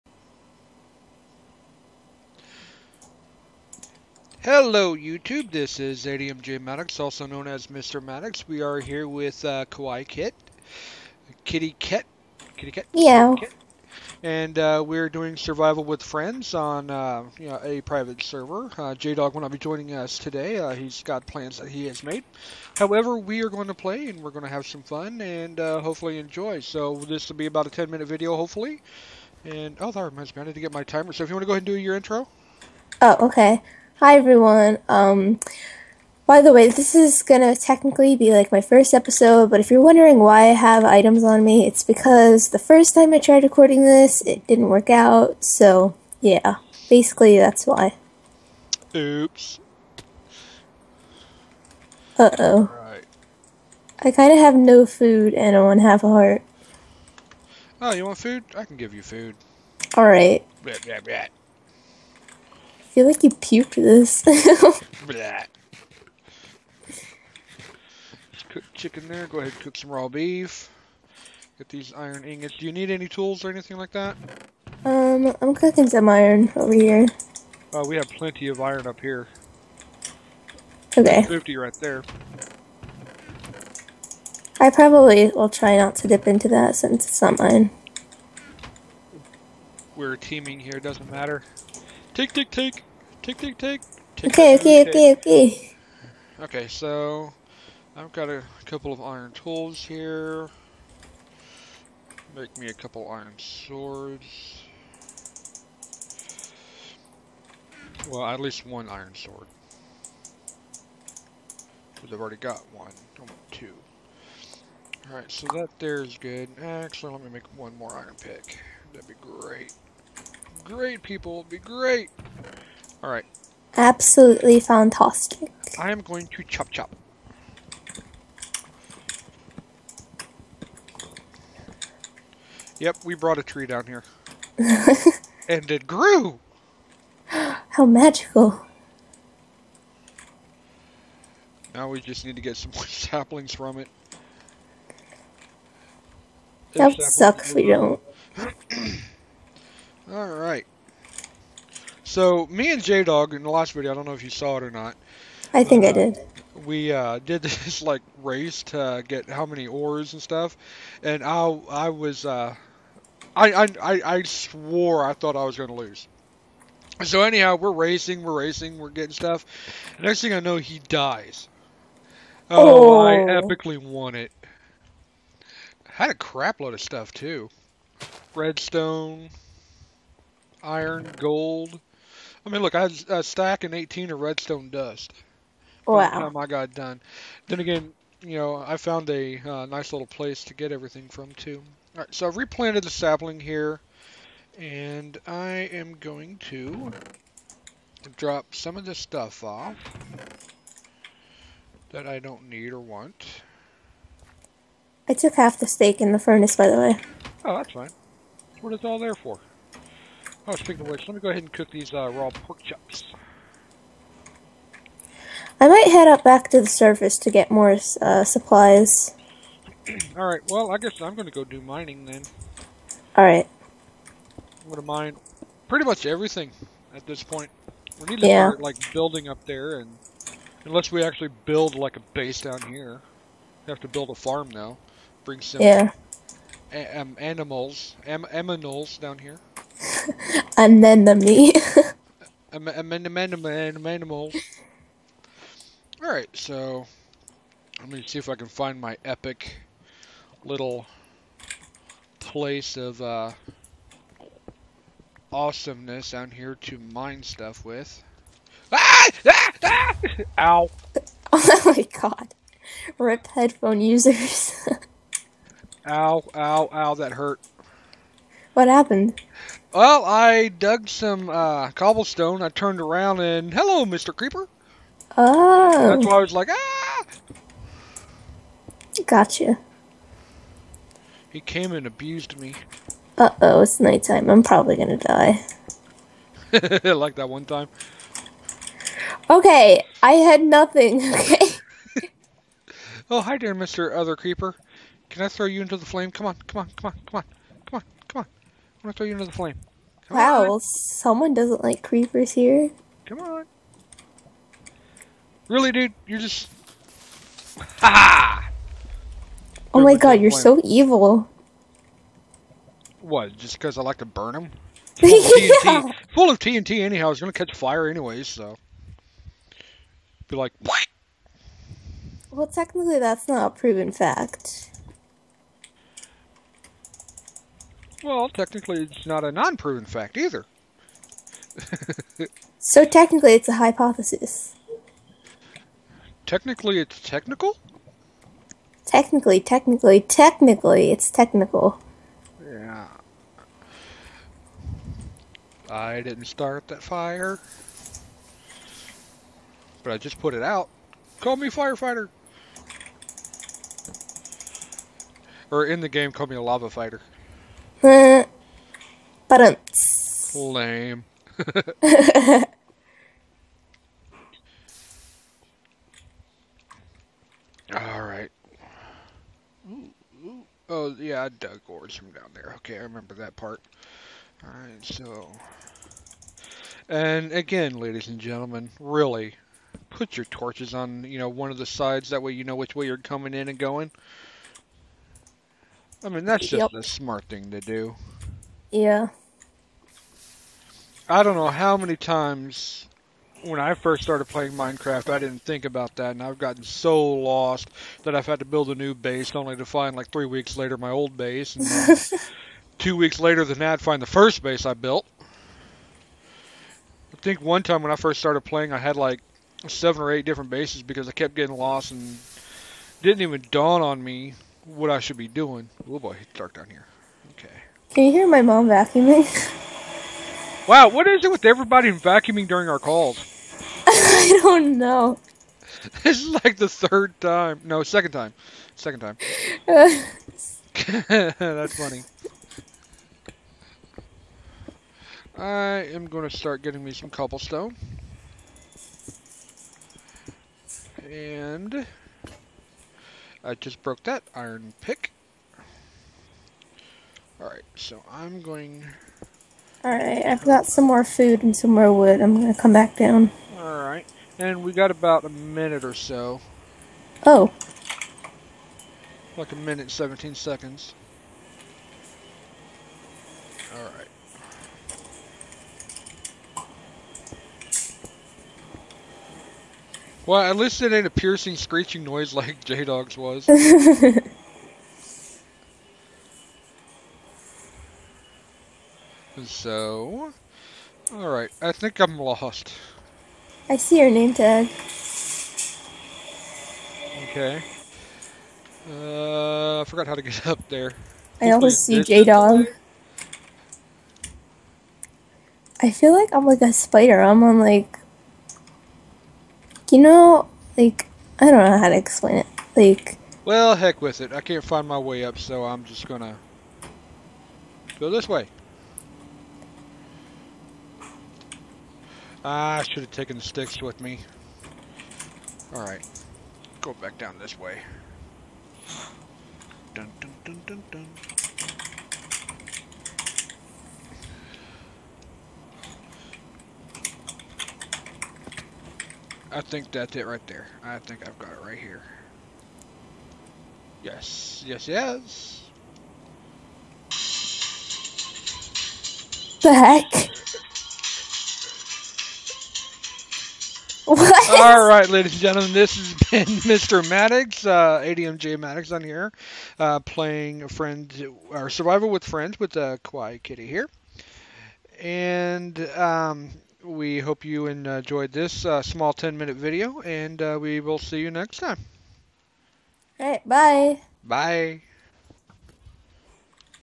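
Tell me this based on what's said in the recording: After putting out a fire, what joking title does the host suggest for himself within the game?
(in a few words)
lava fighter.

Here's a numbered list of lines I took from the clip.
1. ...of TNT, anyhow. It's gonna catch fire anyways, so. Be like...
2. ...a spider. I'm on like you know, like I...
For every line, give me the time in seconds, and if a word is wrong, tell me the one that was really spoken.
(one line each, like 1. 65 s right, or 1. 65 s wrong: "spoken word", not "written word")
1. 316 s right
2. 496 s right.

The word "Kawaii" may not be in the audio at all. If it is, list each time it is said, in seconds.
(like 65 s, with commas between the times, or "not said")
9 s, 553 s.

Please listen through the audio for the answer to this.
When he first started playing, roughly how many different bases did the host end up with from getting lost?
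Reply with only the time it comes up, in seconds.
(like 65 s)
409 s.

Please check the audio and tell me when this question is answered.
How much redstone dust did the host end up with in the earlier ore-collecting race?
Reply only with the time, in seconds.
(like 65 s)
183 s.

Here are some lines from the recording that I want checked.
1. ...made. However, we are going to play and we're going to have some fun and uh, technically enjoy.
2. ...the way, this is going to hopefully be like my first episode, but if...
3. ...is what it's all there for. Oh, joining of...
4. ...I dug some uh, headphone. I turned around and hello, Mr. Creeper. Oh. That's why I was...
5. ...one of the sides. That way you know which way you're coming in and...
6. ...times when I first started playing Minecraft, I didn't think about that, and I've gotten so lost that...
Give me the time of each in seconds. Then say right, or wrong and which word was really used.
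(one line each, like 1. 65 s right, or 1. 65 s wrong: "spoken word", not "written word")
1. 22 s wrong: "hopefully", not "technically"
2. 36 s wrong: "technically", not "hopefully"
3. 208 s wrong: "speaking", not "joining"
4. 270 s wrong: "cobblestone", not "headphone"
5. 381 s right
6. 391 s right.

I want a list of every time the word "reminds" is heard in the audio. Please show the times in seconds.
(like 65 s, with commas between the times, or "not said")
30 s.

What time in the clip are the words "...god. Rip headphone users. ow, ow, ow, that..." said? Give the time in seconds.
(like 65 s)
262 s.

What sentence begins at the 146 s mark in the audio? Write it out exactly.
That would suck if we don't.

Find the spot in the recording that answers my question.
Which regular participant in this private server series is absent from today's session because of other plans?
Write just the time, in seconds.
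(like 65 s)
18 s.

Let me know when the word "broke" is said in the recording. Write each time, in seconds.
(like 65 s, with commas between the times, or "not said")
443 s.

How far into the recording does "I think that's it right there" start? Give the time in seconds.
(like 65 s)
529 s.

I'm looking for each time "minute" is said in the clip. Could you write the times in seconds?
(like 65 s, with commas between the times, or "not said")
27 s, 455 s, 459 s, 559 s.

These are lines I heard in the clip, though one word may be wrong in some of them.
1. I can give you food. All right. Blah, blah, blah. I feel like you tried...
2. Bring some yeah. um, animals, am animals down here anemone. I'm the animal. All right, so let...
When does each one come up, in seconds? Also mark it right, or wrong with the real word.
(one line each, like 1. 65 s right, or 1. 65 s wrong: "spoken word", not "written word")
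1. 58 s wrong: "puked", not "tried"
2. 235 s right.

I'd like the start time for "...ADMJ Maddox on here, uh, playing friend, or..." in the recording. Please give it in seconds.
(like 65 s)
548 s.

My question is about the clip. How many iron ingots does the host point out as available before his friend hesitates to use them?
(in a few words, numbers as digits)
50.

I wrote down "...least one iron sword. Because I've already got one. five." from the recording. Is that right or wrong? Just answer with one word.
wrong.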